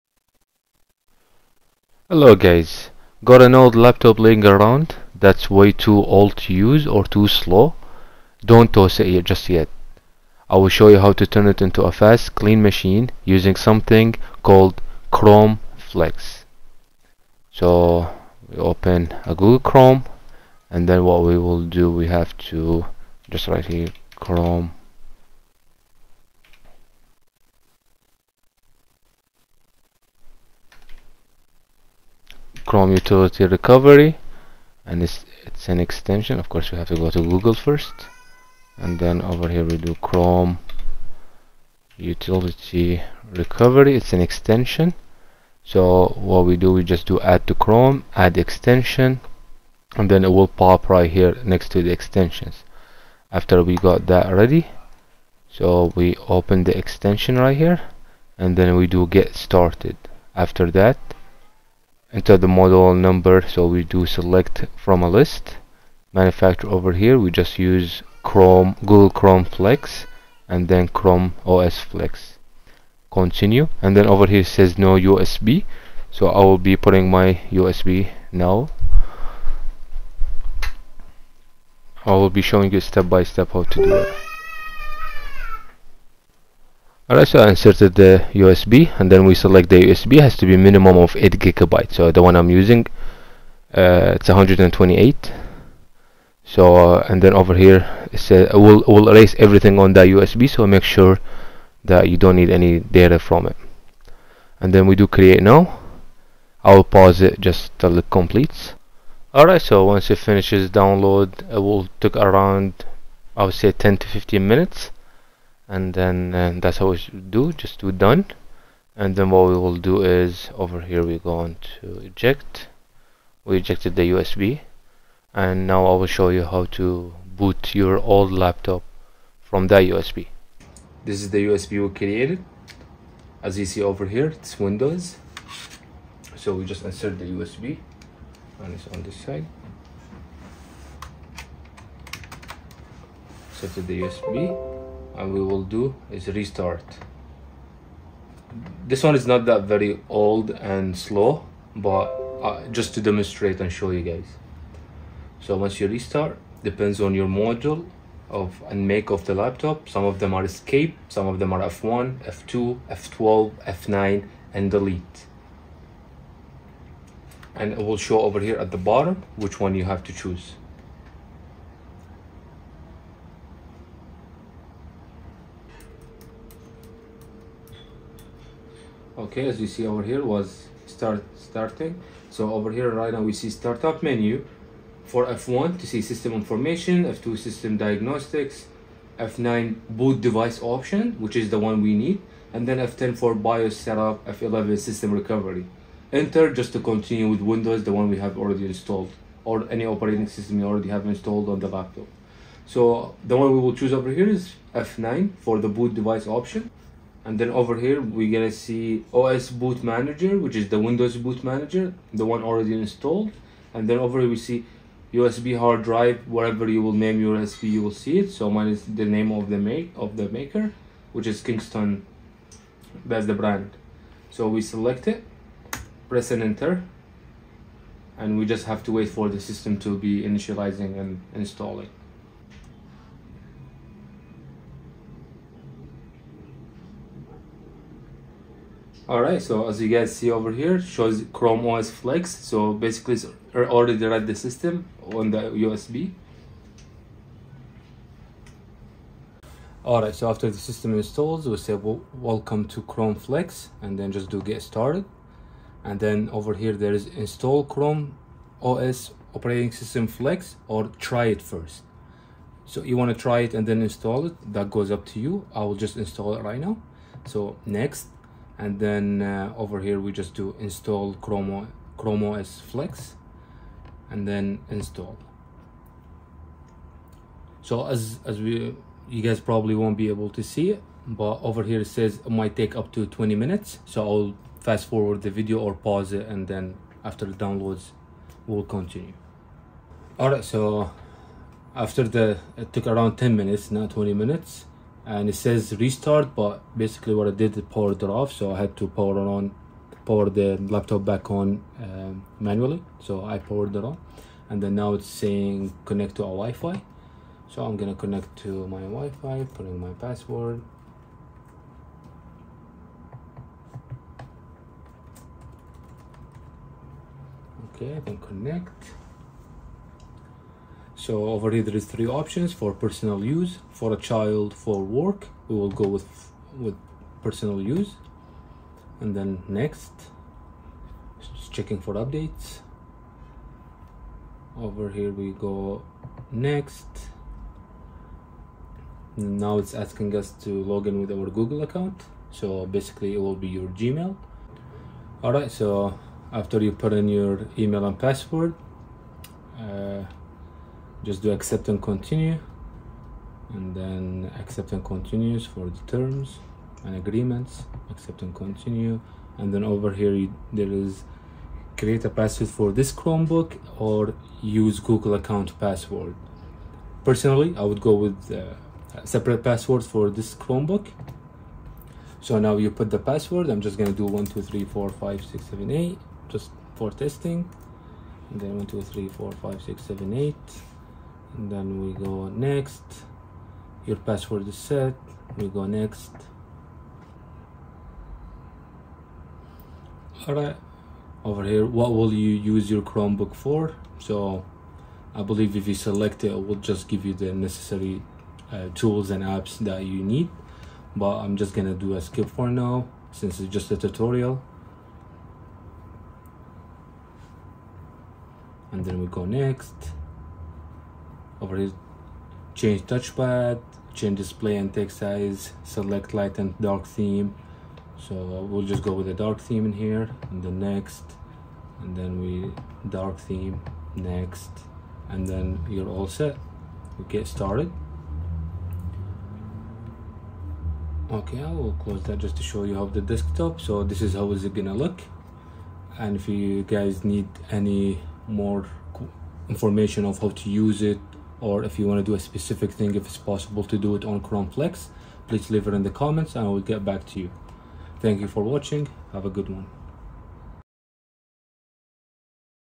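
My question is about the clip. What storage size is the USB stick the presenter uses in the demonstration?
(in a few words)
128.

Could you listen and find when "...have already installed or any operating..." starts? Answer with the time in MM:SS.
03:18.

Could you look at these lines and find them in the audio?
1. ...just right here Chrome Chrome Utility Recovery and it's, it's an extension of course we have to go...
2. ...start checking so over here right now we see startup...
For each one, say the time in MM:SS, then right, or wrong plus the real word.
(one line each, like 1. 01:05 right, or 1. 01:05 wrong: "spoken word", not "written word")
1. 00:23 right
2. 03:00 wrong: "starting", not "checking".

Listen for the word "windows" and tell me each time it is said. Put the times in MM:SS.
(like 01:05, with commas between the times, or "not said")
02:14, 03:17, 03:30.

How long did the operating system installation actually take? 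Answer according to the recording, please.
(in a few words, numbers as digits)
10 minutes.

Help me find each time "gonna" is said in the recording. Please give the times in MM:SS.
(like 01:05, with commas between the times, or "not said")
03:28, 05:07, 06:41, 07:14.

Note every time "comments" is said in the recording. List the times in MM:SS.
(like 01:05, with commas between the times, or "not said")
07:25.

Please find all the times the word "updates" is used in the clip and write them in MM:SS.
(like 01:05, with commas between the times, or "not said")
05:31.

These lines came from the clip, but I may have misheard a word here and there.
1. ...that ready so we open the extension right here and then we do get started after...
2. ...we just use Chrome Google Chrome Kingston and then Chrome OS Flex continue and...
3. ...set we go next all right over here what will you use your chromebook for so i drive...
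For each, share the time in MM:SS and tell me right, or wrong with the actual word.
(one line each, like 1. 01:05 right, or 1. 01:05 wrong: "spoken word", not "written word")
1. 00:54 right
2. 01:07 wrong: "Flex", not "Kingston"
3. 06:24 wrong: "believe", not "drive".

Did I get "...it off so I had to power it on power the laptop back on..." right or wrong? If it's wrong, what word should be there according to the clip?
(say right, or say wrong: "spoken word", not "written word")
right.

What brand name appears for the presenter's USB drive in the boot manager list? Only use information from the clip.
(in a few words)
Kingston.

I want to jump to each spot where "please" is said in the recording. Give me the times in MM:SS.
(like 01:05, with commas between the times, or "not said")
07:25.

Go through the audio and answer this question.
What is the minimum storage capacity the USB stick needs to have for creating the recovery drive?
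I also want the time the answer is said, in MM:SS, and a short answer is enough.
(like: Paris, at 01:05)
8 gigabytes, at 01:31.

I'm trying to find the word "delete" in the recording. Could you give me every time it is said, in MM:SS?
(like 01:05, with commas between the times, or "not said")
02:44.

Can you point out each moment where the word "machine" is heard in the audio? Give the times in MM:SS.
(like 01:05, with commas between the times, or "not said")
00:12.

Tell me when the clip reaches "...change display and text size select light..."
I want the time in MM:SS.
06:53.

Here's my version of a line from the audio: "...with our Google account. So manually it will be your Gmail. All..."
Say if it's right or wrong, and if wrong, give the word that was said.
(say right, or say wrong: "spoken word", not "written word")
wrong: "basically", not "manually".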